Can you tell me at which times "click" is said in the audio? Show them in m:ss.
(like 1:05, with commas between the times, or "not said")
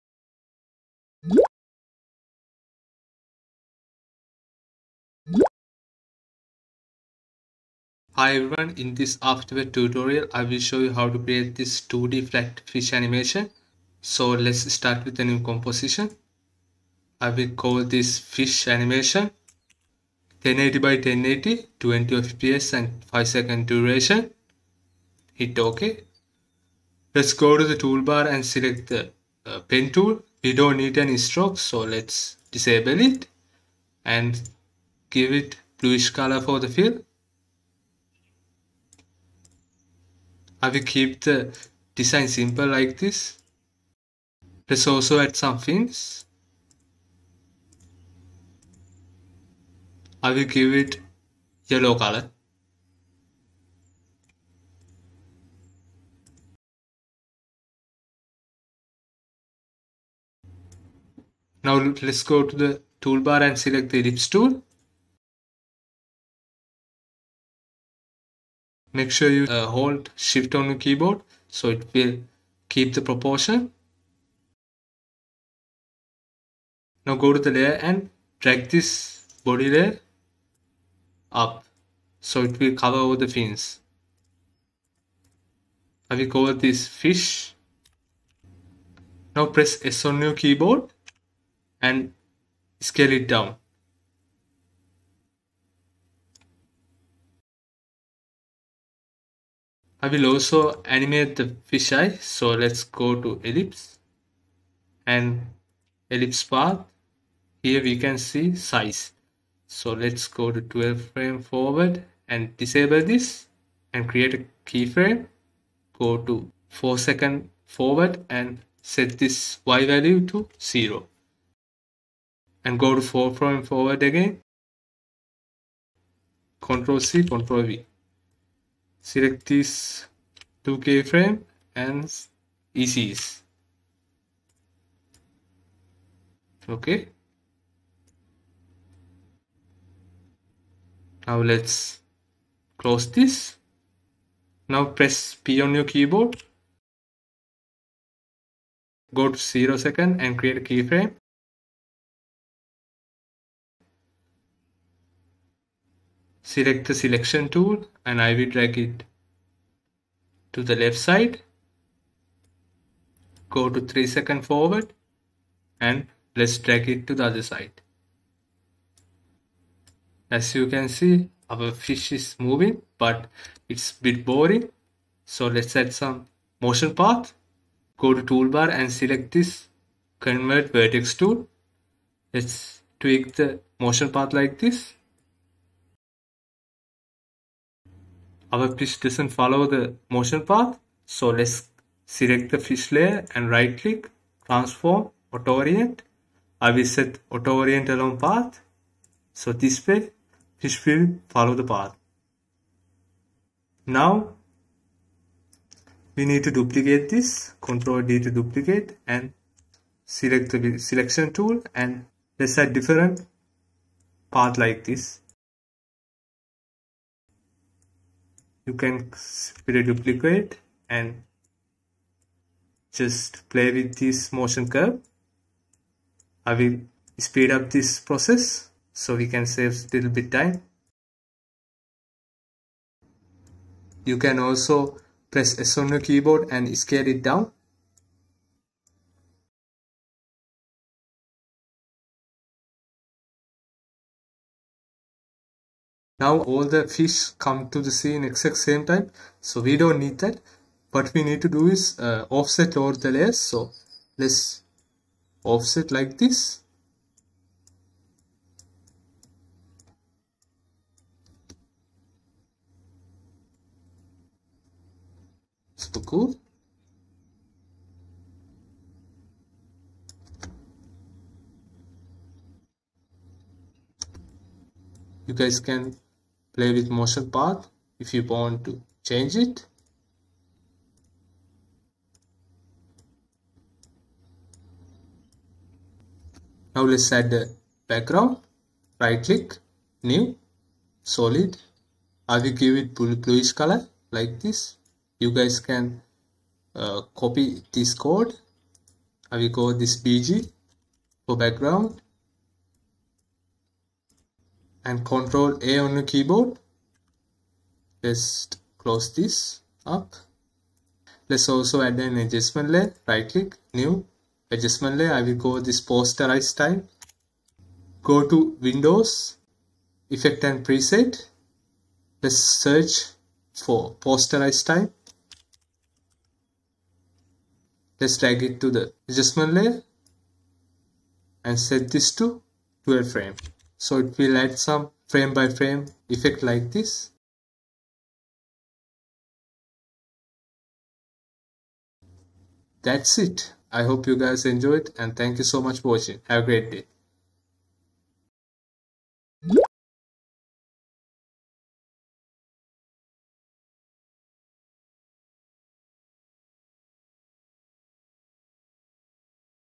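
3:13, 4:49, 5:13.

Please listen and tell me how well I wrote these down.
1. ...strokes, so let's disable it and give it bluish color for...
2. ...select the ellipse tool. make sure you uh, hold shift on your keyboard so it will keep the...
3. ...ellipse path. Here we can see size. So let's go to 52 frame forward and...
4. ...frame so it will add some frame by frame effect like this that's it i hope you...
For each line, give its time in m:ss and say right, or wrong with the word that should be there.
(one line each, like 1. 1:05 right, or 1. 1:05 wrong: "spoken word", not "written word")
1. 0:31 right
2. 1:03 right
3. 1:46 wrong: "12", not "52"
4. 5:33 right.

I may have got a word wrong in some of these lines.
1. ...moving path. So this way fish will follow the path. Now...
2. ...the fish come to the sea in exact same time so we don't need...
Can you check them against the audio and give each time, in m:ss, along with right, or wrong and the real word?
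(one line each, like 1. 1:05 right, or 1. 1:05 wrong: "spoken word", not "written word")
1. 3:17 wrong: "along", not "moving"
2. 4:06 right.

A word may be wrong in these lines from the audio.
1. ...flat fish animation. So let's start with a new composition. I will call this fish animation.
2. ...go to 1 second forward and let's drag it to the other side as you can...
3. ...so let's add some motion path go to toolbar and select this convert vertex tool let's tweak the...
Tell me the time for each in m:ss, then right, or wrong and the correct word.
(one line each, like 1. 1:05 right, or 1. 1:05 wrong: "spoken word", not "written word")
1. 0:12 right
2. 2:43 wrong: "3", not "1"
3. 2:55 right.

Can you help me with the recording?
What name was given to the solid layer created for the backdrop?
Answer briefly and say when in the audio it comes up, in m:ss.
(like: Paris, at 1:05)
BG, at 5:00.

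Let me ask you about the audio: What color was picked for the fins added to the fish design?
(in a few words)
yellow.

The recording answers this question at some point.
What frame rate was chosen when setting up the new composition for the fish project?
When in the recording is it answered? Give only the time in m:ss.
0:21.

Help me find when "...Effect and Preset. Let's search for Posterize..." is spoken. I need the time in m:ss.
5:20.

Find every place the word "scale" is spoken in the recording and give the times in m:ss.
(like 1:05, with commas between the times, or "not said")
1:32, 3:56.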